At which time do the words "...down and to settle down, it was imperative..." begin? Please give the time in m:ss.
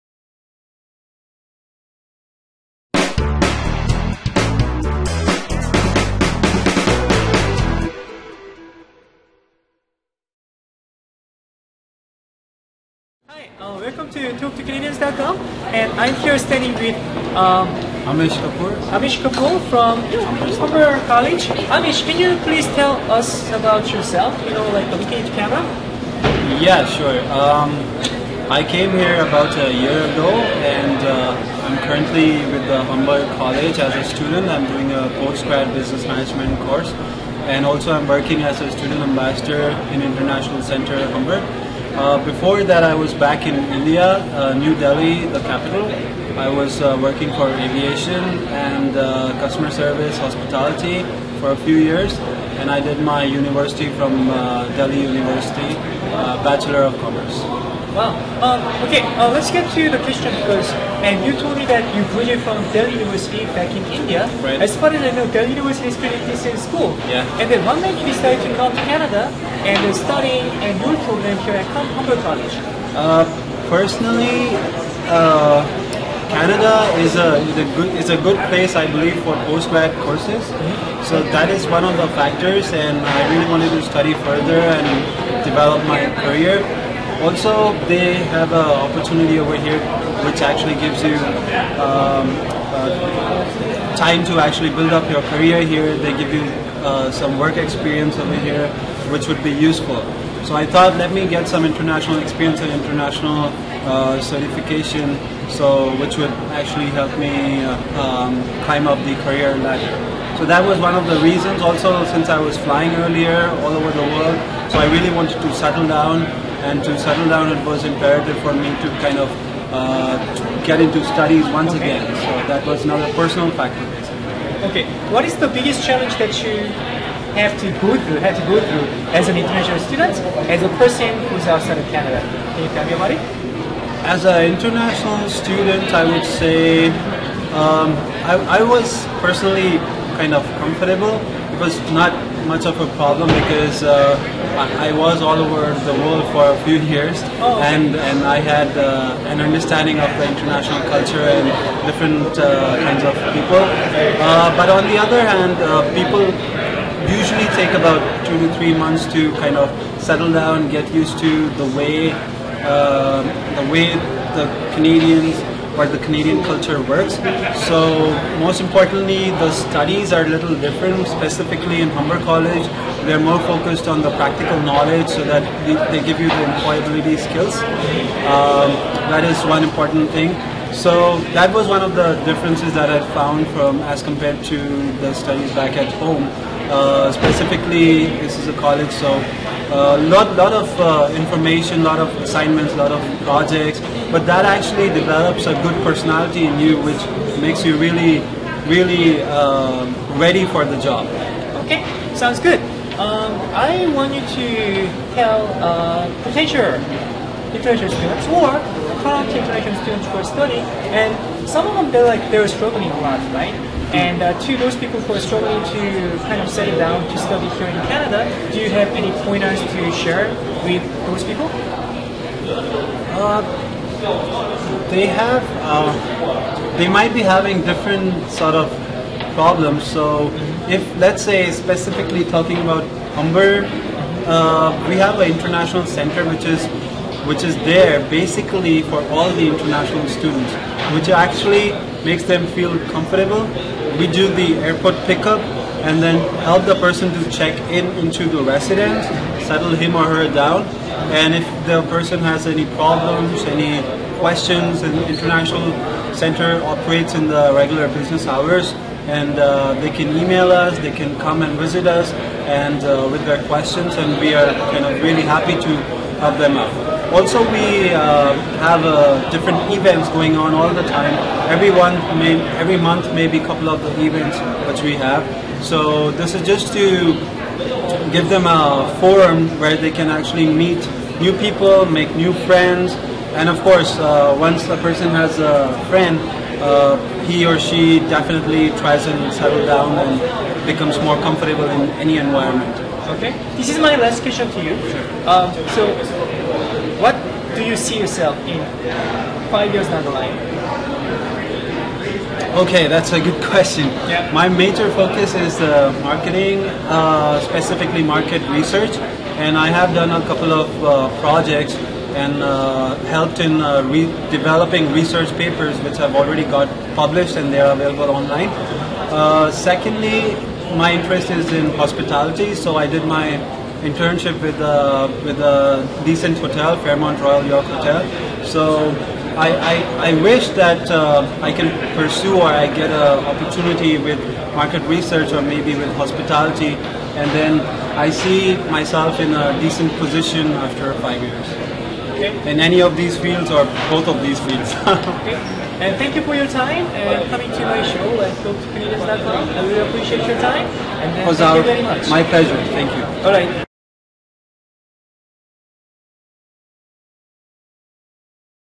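1:55.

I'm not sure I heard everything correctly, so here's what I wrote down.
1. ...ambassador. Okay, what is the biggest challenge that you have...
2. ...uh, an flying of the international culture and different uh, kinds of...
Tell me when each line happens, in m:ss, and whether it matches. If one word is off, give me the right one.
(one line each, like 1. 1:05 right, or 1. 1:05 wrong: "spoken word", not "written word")
1. 2:03 wrong: "factor", not "ambassador"
2. 2:28 wrong: "understanding", not "flying".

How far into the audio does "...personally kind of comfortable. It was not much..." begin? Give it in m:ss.
2:19.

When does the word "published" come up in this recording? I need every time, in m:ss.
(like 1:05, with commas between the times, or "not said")
5:16.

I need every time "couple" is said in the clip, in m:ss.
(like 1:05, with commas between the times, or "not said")
4:33, 5:10.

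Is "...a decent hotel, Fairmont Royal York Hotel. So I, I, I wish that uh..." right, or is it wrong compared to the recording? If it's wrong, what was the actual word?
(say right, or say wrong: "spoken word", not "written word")
right.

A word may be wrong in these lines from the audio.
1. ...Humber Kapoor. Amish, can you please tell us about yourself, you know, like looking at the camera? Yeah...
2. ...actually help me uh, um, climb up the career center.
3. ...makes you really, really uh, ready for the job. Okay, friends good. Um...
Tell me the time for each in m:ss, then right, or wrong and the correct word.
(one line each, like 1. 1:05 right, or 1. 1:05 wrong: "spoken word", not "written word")
1. 0:20 wrong: "College", not "Kapoor"
2. 1:46 wrong: "ladder", not "center"
3. 3:17 wrong: "sounds", not "friends".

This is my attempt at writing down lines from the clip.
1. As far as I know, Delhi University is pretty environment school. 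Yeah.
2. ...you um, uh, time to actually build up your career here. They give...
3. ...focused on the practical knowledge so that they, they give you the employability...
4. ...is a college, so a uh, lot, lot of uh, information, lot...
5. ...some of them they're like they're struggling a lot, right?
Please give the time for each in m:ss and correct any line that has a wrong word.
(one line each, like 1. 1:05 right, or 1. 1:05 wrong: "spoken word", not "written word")
1. 1:04 wrong: "decent", not "environment"
2. 1:31 right
3. 2:53 right
4. 3:08 right
5. 3:31 right.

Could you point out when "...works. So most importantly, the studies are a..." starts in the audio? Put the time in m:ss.
2:46.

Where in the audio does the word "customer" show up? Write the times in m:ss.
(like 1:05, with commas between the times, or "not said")
0:49.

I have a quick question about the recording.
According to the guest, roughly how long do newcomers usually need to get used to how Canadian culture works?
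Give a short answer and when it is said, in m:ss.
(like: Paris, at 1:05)
2 to 3 months, at 2:38.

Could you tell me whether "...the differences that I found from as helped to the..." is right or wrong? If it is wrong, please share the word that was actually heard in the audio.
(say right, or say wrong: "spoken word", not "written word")
wrong: "compared", not "helped".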